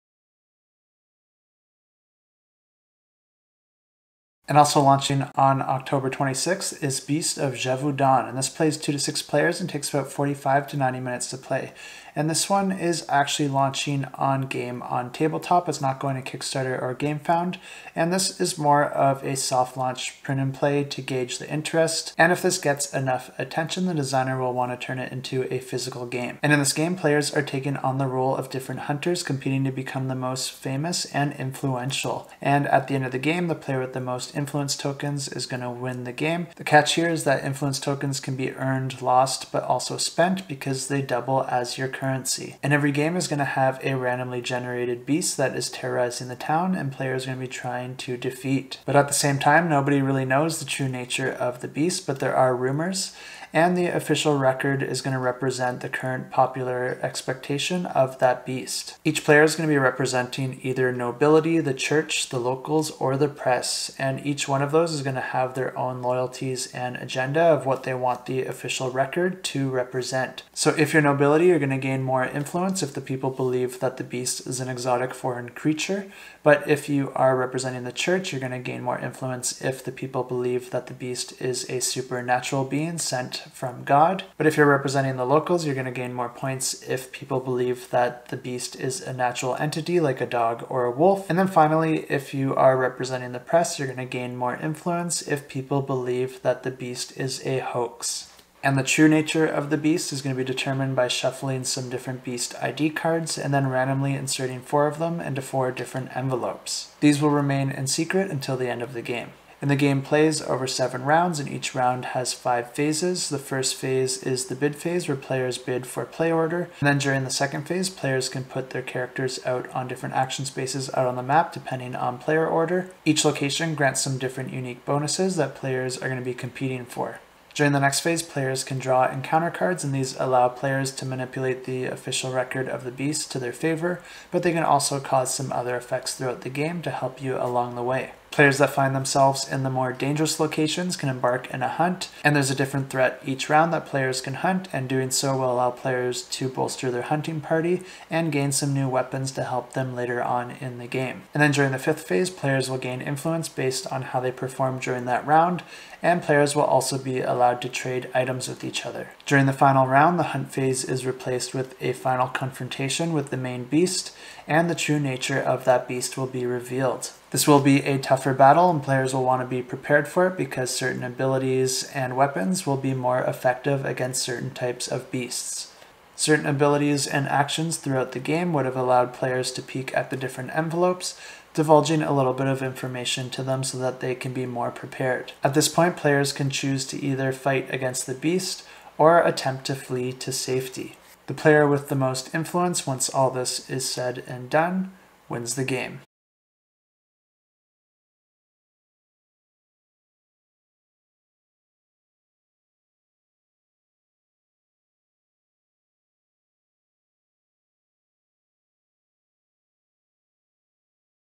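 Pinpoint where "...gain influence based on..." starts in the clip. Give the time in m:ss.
2:32.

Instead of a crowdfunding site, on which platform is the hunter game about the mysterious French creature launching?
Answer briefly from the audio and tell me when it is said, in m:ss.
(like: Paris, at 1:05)
Game on Tabletop, at 0:14.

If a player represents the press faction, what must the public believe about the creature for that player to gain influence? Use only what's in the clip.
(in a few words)
A hoax.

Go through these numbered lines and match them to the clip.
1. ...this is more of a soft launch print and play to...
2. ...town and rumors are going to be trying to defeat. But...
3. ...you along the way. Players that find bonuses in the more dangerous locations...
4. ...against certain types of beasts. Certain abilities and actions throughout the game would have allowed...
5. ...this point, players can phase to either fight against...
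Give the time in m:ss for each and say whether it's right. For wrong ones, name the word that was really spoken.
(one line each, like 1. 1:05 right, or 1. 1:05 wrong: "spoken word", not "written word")
1. 0:18 right
2. 0:46 wrong: "players", not "rumors"
3. 2:17 wrong: "themselves", not "bonuses"
4. 2:53 right
5. 3:05 wrong: "choose", not "phase".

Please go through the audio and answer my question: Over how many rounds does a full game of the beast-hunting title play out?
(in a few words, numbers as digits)
7.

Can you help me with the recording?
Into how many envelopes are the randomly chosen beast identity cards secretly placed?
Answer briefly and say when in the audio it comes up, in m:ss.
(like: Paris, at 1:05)
4, at 1:45.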